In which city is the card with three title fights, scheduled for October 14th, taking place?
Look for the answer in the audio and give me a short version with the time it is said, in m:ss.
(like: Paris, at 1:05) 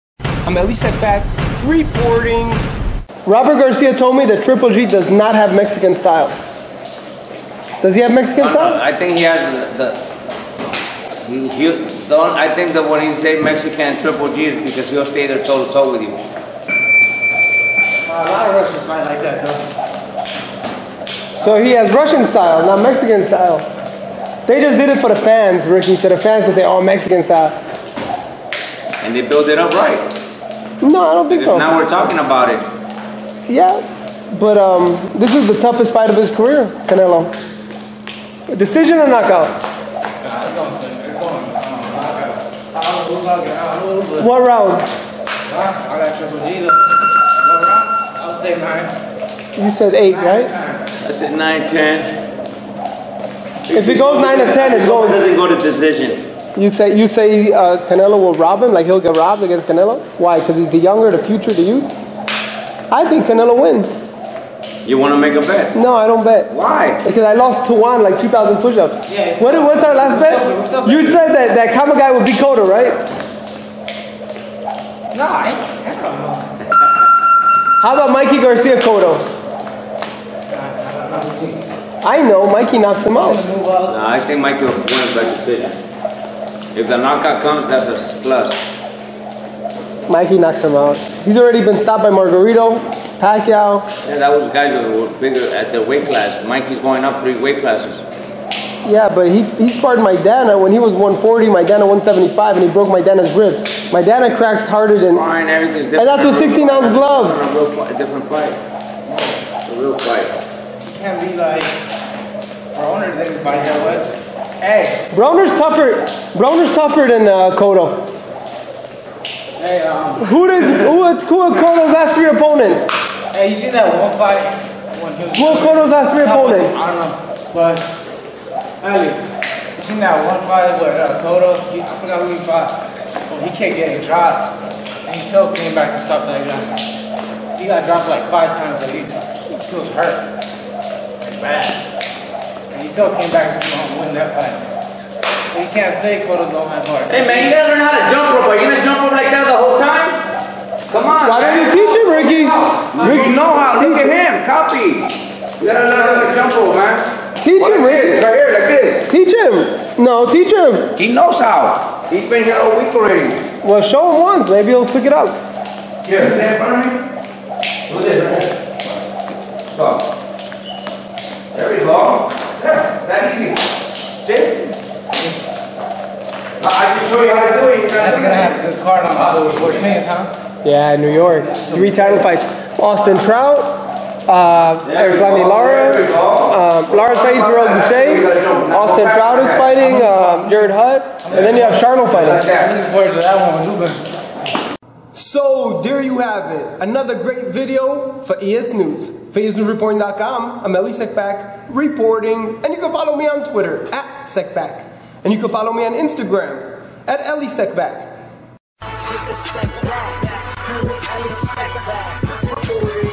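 New York, at 3:00.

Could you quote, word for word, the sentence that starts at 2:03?
Hey, you seen that one fight One he Who are Cotto's last three opponents?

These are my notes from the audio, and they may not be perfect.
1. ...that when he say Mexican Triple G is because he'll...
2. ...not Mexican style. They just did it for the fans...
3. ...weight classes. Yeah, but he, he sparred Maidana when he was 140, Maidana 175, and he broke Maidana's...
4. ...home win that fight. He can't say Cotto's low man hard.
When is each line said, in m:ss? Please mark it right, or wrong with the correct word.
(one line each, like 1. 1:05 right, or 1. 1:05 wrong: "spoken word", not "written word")
1. 0:12 right
2. 0:22 right
3. 1:37 right
4. 2:23 right.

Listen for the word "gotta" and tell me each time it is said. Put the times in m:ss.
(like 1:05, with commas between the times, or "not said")
2:27, 2:35.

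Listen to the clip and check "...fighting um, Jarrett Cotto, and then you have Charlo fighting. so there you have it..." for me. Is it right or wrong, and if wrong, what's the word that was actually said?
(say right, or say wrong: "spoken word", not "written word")
wrong: "Hurd", not "Cotto".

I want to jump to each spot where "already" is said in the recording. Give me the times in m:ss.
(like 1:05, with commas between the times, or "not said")
1:31, 2:42.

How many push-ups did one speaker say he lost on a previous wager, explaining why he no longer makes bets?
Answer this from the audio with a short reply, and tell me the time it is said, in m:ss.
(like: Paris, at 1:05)
2,000, at 1:08.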